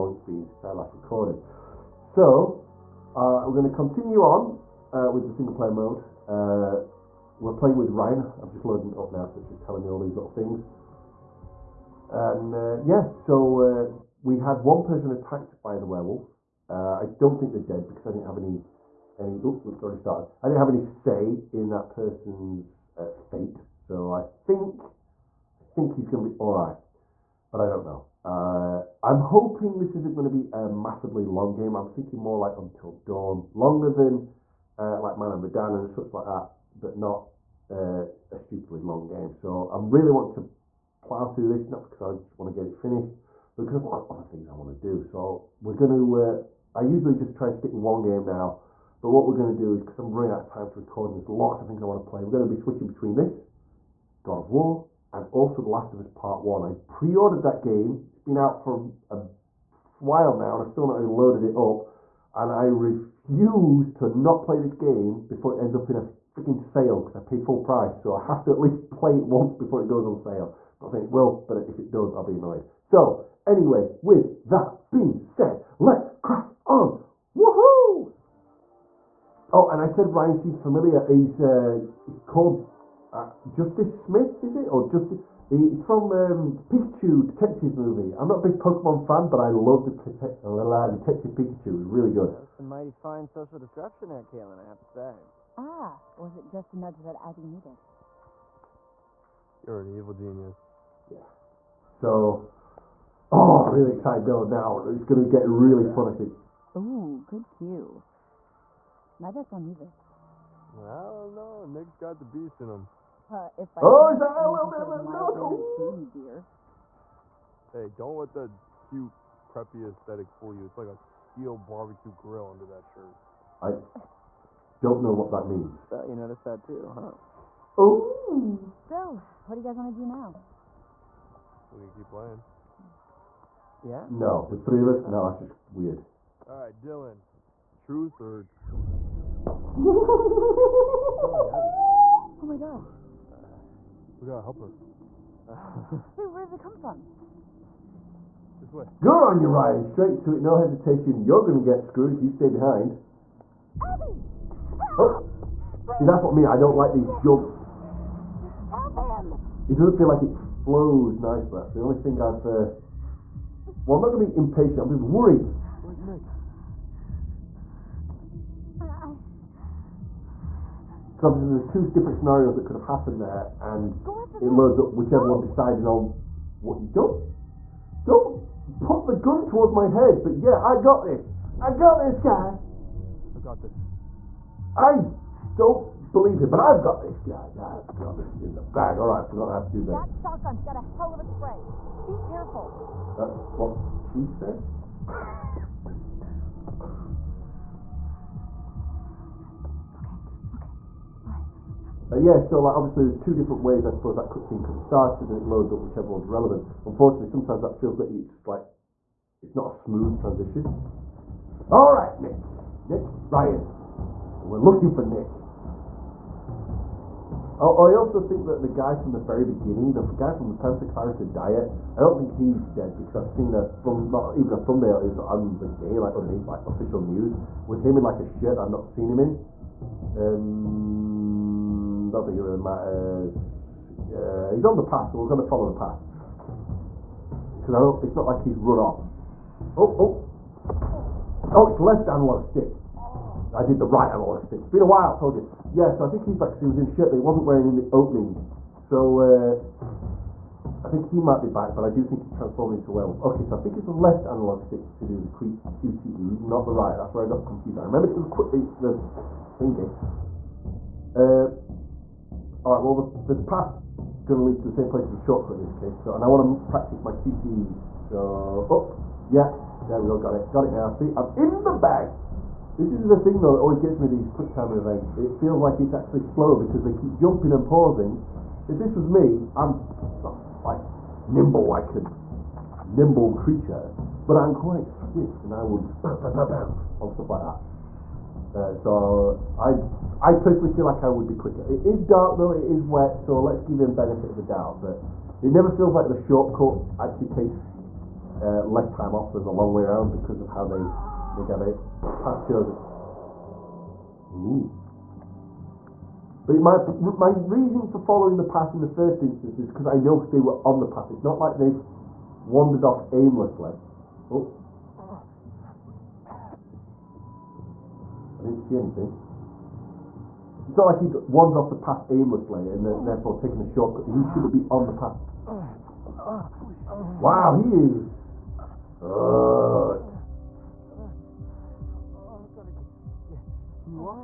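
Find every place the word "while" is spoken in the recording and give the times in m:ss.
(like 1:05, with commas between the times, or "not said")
1:00, 4:04.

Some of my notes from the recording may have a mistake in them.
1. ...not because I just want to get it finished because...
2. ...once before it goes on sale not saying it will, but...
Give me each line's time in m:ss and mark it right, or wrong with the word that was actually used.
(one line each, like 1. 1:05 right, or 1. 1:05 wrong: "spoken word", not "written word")
1. 0:41 right
2. 1:09 right.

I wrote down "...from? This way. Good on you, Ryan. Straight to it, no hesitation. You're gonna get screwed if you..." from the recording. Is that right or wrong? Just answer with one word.
right.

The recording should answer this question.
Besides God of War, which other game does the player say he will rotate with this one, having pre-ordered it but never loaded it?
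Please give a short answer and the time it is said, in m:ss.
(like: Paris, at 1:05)
The Last of Us Part 1, at 0:55.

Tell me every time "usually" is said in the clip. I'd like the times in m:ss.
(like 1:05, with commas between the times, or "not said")
0:46.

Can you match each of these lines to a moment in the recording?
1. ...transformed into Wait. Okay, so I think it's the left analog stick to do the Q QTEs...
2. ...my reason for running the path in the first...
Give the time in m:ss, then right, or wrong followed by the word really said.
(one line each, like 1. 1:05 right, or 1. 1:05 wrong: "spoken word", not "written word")
1. 4:12 wrong: "Werewolf", not "Wait"
2. 5:07 wrong: "following", not "running".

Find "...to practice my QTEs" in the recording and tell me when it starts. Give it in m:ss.
4:26.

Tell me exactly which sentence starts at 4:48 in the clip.
Uh, so I, I personally feel like I would be quicker.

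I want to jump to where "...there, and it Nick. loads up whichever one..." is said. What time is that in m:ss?
2:53.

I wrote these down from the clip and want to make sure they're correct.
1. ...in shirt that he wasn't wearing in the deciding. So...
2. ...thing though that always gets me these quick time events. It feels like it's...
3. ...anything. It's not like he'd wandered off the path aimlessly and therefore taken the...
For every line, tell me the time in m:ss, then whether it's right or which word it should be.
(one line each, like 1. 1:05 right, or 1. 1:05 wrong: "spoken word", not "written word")
1. 4:06 wrong: "opening", not "deciding"
2. 4:33 right
3. 5:18 right.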